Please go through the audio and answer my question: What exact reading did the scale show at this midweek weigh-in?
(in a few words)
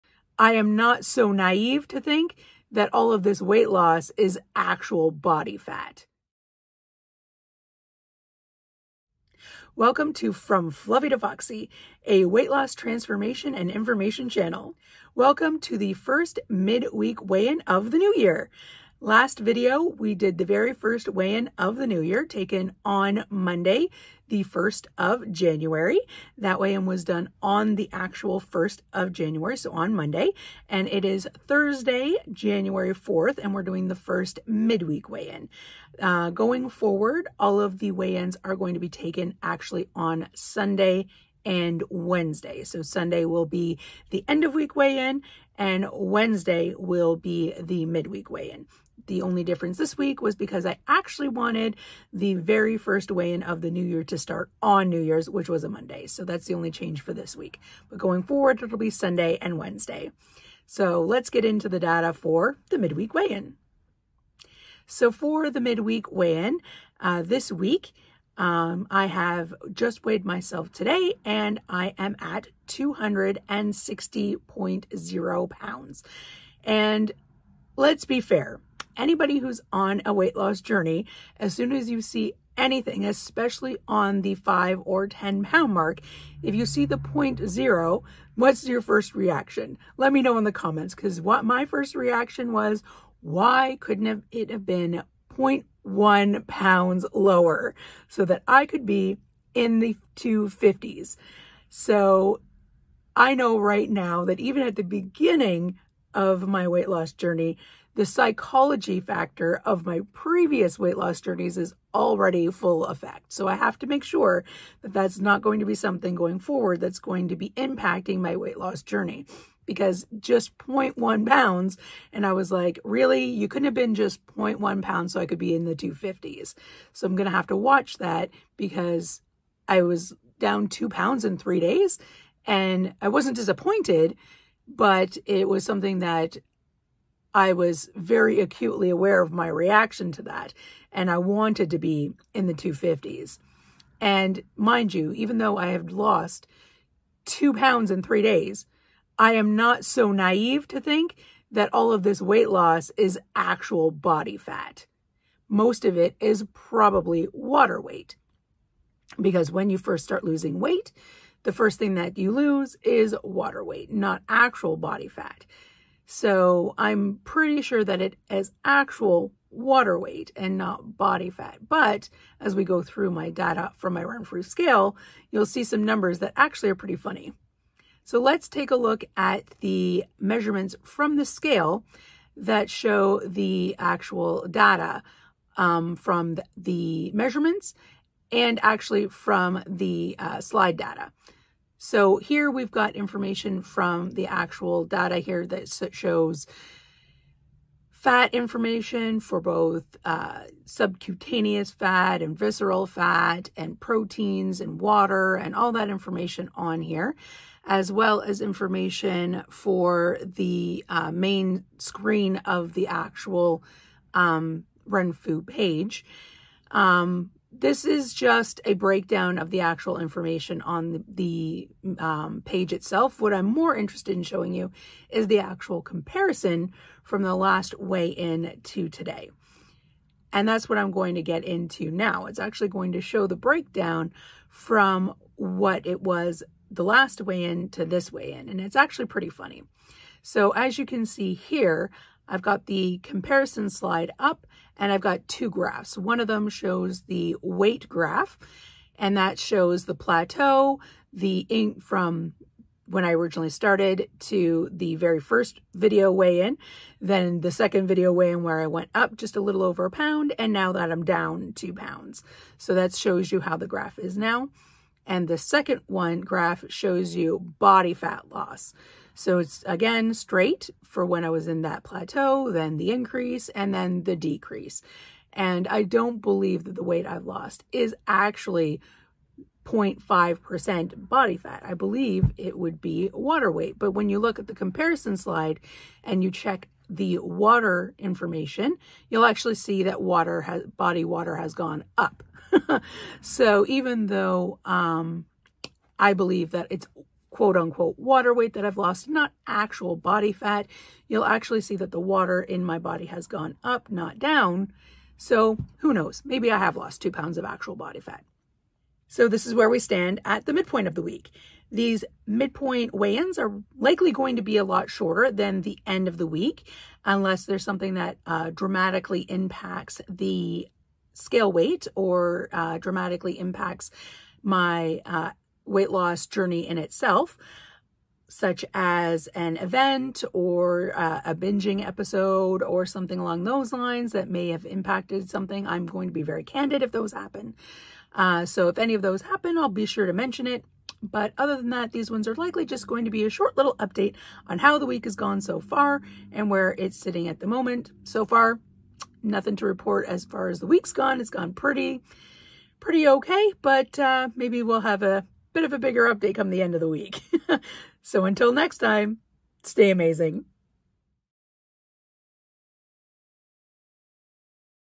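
260.0 pounds.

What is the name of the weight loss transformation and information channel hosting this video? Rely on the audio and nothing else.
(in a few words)
From Fluffy to Foxy.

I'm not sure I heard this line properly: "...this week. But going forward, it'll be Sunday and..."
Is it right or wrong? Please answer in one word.
right.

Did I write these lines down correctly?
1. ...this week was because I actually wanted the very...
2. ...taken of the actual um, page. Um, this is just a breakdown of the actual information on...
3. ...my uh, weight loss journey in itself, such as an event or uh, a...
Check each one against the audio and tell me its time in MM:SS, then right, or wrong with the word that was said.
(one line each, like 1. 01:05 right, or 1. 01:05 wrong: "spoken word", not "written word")
1. 00:49 right
2. 03:31 wrong: "screen", not "taken"
3. 05:24 right.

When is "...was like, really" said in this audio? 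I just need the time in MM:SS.
02:02.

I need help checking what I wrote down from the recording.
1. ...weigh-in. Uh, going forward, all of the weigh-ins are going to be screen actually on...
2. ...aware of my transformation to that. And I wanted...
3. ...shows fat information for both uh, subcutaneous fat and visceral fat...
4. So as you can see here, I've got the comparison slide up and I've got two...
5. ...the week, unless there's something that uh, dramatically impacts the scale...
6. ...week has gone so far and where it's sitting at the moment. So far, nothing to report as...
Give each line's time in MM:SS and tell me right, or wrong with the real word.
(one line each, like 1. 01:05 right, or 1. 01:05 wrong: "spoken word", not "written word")
1. 00:35 wrong: "taken", not "screen"
2. 02:18 wrong: "reaction", not "transformation"
3. 03:15 right
4. 04:00 right
5. 05:16 right
6. 05:44 right.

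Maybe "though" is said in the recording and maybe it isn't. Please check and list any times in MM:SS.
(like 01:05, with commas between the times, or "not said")
02:25, 04:54.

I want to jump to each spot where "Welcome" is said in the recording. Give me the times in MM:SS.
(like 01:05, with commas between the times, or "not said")
00:09, 00:15.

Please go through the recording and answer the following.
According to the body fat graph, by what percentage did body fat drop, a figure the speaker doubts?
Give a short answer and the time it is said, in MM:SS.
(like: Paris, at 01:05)
0.5%, at 04:39.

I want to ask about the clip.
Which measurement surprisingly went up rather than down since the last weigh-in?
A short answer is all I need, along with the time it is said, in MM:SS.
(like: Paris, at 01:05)
body water, at 04:50.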